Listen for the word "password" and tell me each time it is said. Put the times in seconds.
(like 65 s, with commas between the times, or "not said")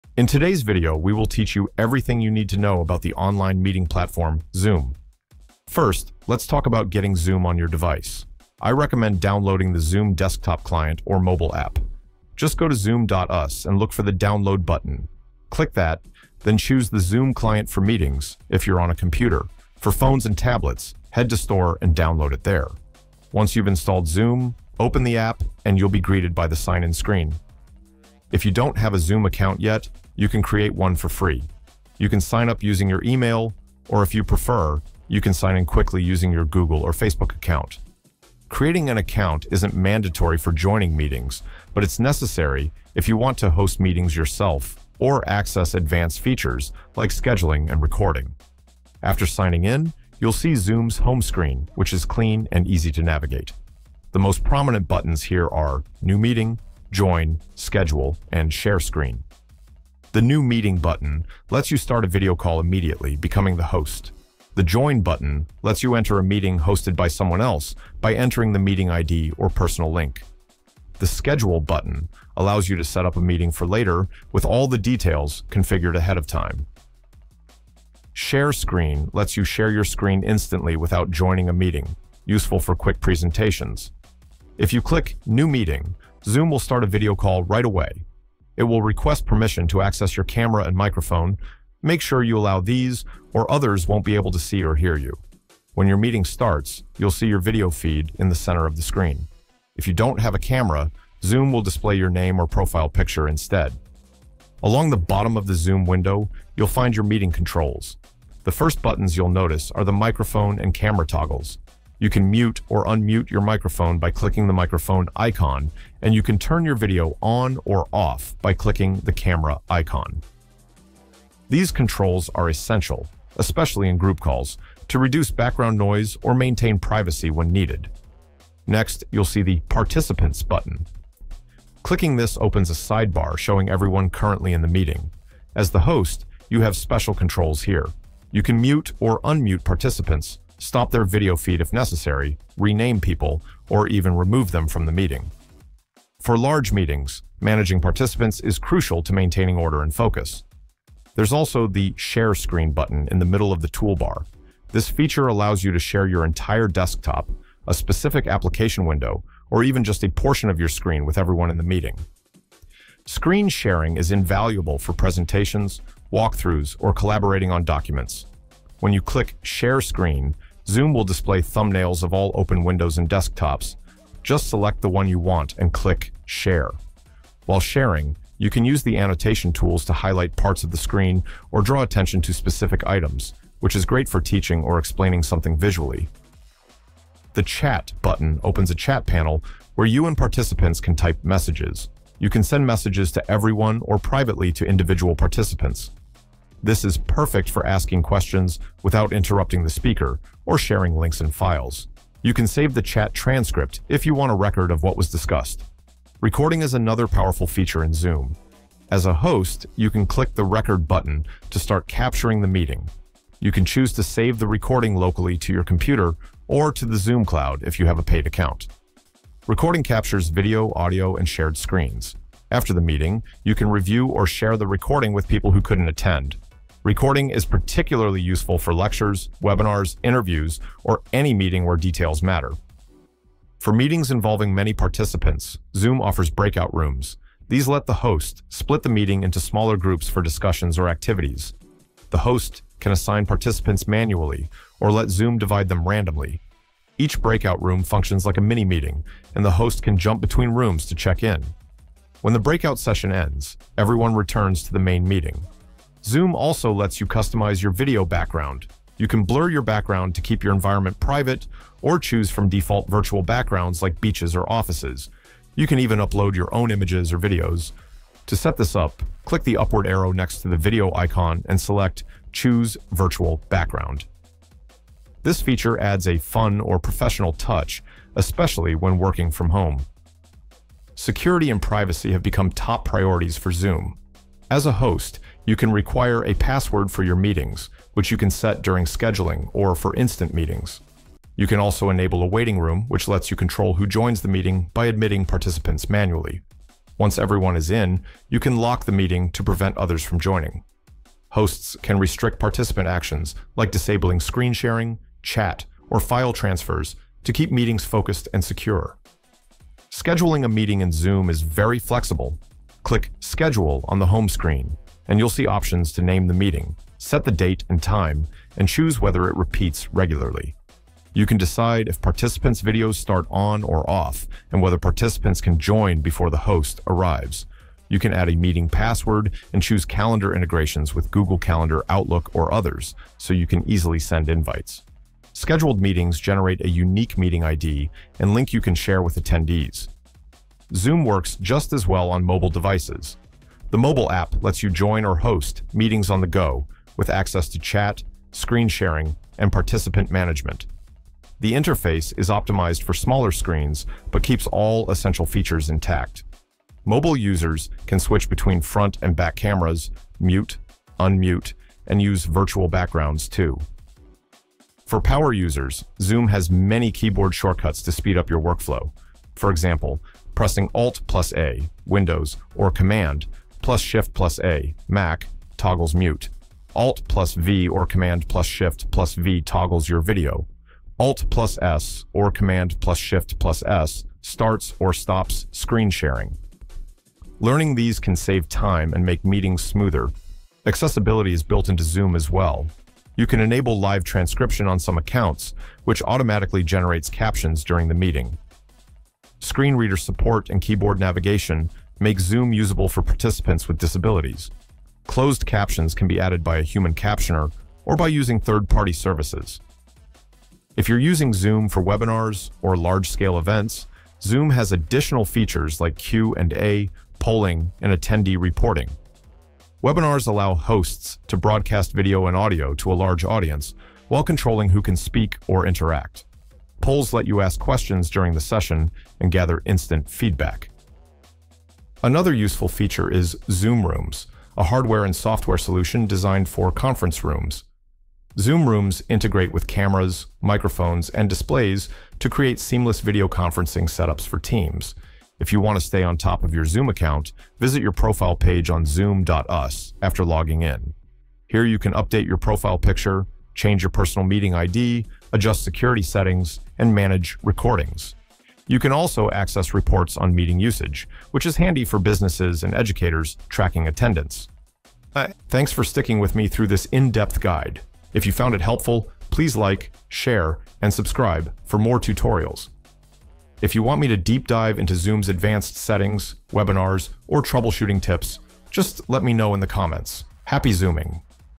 286 s, 328 s.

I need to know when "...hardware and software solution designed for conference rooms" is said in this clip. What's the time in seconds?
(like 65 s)
434 s.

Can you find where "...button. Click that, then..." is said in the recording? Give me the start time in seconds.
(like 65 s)
14 s.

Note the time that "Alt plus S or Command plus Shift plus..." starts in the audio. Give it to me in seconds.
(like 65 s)
380 s.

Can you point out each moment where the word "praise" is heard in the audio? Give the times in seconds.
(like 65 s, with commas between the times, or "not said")
not said.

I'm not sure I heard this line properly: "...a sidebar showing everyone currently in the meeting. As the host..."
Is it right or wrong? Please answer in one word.
right.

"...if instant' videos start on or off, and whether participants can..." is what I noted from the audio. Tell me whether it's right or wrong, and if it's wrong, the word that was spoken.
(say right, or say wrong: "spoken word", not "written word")
wrong: "participants", not "instant".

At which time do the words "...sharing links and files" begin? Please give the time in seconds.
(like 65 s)
200 s.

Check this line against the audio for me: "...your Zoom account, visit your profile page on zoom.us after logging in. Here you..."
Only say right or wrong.
right.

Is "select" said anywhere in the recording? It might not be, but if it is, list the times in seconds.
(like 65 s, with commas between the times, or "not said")
174 s, 271 s.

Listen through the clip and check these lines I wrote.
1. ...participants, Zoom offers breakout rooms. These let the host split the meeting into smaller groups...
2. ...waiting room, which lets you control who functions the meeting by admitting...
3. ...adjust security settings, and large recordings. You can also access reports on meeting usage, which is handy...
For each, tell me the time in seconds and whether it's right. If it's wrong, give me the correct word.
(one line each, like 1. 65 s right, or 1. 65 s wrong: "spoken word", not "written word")
1. 234 s right
2. 292 s wrong: "joins", not "functions"
3. 455 s wrong: "manage", not "large".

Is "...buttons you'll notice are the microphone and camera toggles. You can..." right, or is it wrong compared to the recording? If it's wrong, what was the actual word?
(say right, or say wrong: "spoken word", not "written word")
right.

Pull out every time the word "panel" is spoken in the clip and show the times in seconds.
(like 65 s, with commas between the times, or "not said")
189 s.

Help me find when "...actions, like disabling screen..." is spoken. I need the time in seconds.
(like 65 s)
302 s.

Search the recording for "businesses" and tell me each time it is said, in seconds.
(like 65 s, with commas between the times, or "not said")
461 s.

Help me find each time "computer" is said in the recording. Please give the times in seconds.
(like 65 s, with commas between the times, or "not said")
18 s, 215 s.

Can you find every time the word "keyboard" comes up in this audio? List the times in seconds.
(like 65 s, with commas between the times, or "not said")
366 s, 400 s.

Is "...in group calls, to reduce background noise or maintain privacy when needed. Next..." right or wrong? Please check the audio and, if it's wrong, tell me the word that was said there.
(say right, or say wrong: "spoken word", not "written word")
right.